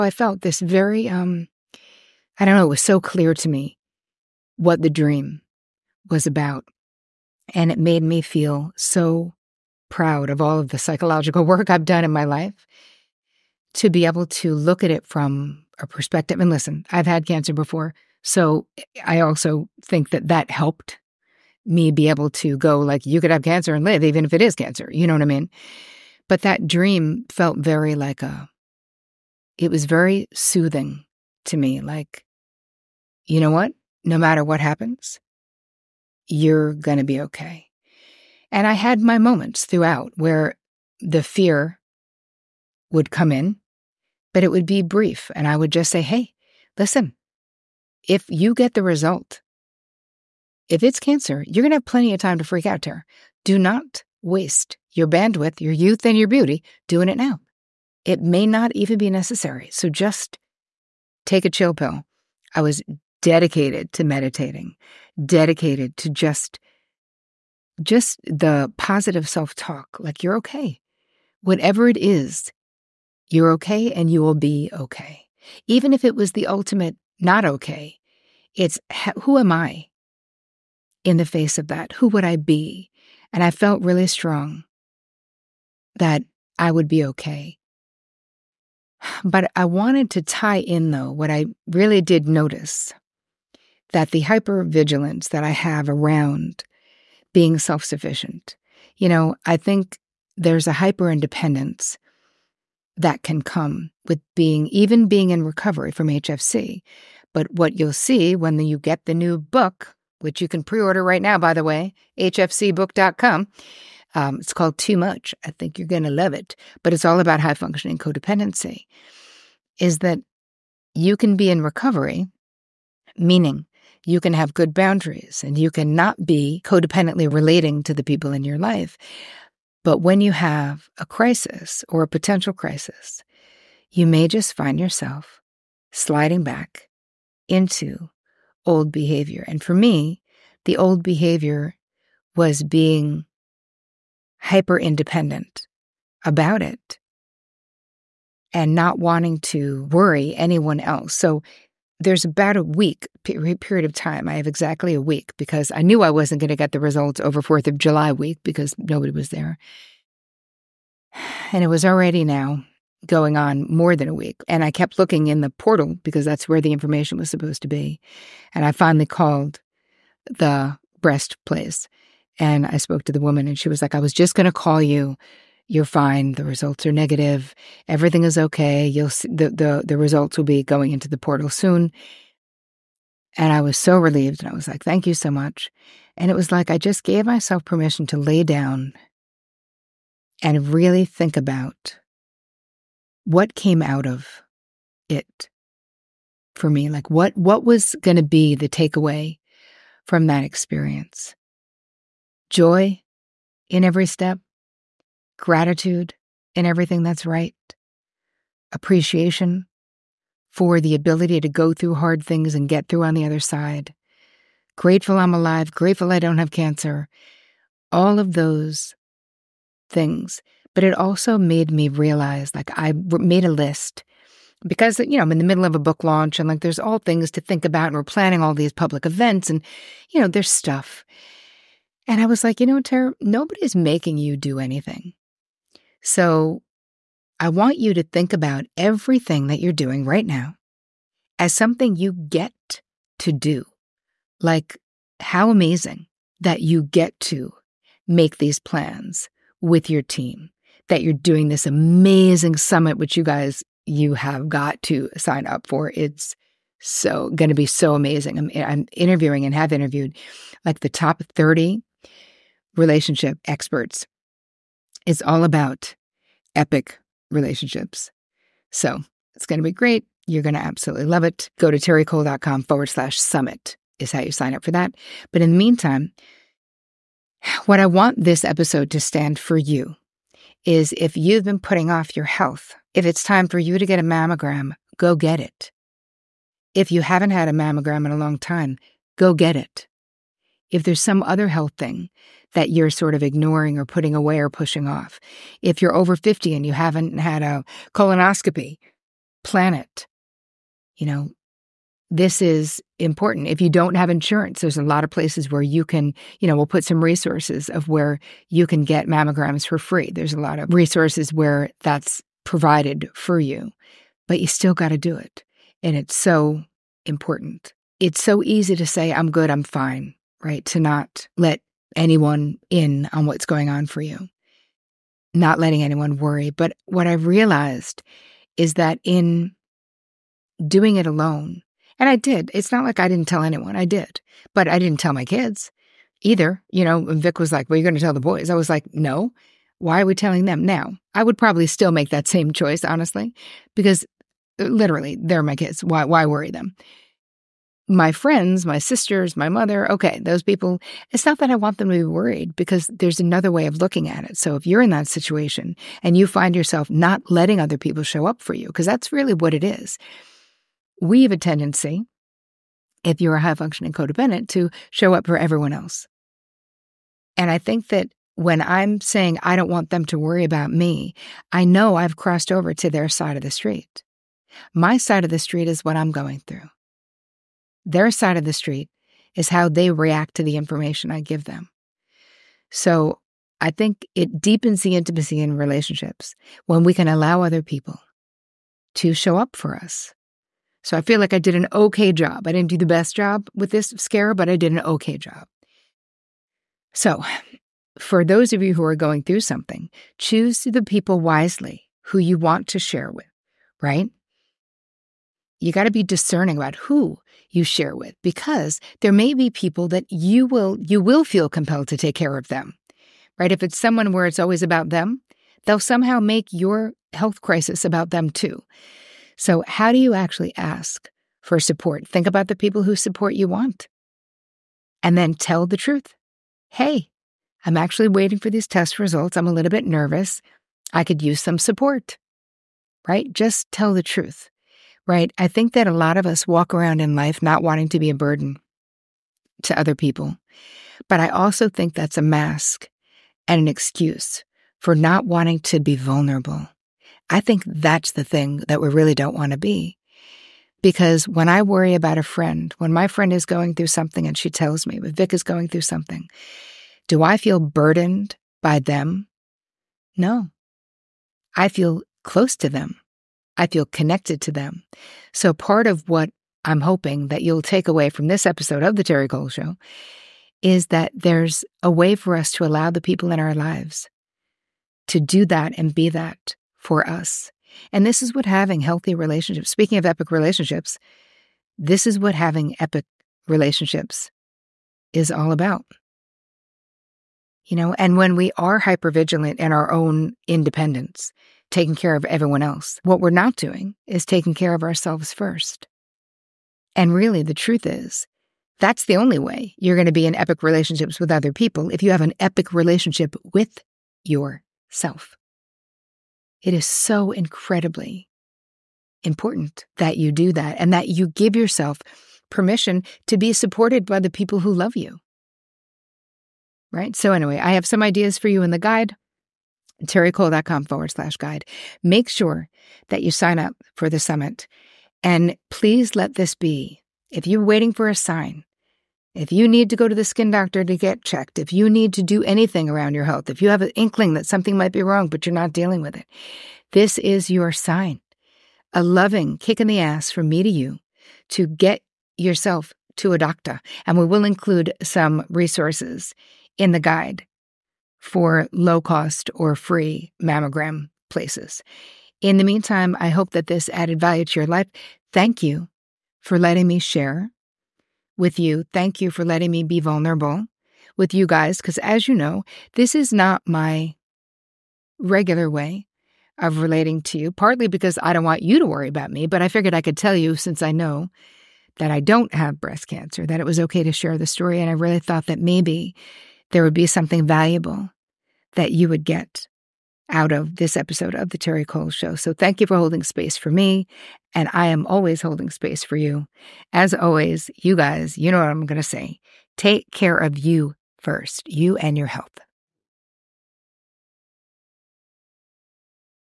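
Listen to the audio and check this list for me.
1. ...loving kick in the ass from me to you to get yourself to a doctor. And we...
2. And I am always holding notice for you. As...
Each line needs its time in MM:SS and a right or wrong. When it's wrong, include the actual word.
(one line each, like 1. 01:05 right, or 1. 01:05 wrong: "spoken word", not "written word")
1. 08:59 right
2. 09:44 wrong: "space", not "notice".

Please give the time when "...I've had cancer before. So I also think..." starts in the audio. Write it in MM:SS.
00:16.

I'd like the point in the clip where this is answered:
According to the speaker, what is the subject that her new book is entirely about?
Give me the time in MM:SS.
01:57.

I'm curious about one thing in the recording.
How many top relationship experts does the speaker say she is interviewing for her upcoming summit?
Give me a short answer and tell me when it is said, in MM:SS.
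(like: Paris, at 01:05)
30, at 04:21.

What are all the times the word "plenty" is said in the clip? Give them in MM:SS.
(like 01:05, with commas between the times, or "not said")
00:51.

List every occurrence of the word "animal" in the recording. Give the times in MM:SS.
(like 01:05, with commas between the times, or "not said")
not said.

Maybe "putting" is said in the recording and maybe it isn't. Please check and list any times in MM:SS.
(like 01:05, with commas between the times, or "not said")
04:41, 04:53.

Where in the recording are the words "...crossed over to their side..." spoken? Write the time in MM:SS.
06:12.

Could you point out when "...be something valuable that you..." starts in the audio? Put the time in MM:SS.
09:36.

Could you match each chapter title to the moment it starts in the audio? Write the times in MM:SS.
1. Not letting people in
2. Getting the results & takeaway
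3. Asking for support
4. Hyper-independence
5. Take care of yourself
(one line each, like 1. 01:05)
1. 05:20
2. 02:41
3. 06:40
4. 01:33
5. 04:42.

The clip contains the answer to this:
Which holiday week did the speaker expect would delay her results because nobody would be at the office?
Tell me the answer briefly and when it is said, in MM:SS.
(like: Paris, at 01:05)
4th of July, at 02:37.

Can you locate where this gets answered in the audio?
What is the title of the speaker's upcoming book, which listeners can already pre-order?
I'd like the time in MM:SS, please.
01:54.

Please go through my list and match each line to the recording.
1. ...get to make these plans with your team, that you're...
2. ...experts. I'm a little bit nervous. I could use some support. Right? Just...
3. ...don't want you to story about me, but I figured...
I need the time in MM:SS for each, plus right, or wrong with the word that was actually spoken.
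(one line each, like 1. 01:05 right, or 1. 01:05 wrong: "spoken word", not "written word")
1. 04:06 right
2. 07:08 wrong: "results", not "experts"
3. 09:28 wrong: "worry", not "story".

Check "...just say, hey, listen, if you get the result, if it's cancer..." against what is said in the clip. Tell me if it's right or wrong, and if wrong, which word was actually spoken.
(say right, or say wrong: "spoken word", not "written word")
right.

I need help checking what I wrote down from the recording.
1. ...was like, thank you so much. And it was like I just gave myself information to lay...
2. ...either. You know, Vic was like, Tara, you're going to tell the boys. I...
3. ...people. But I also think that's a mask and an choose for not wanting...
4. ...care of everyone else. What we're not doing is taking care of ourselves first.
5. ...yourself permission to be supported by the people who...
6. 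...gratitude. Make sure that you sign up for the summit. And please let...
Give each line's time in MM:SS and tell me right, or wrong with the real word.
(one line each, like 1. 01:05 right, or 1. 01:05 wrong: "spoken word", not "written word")
1. 03:04 wrong: "permission", not "information"
2. 05:36 wrong: "Well", not "Tara"
3. 07:19 wrong: "excuse", not "choose"
4. 08:11 right
5. 08:31 right
6. 08:41 wrong: "guide", not "gratitude".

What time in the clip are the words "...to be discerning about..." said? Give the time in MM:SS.
06:45.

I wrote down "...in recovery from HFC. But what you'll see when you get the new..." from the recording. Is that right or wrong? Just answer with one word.
right.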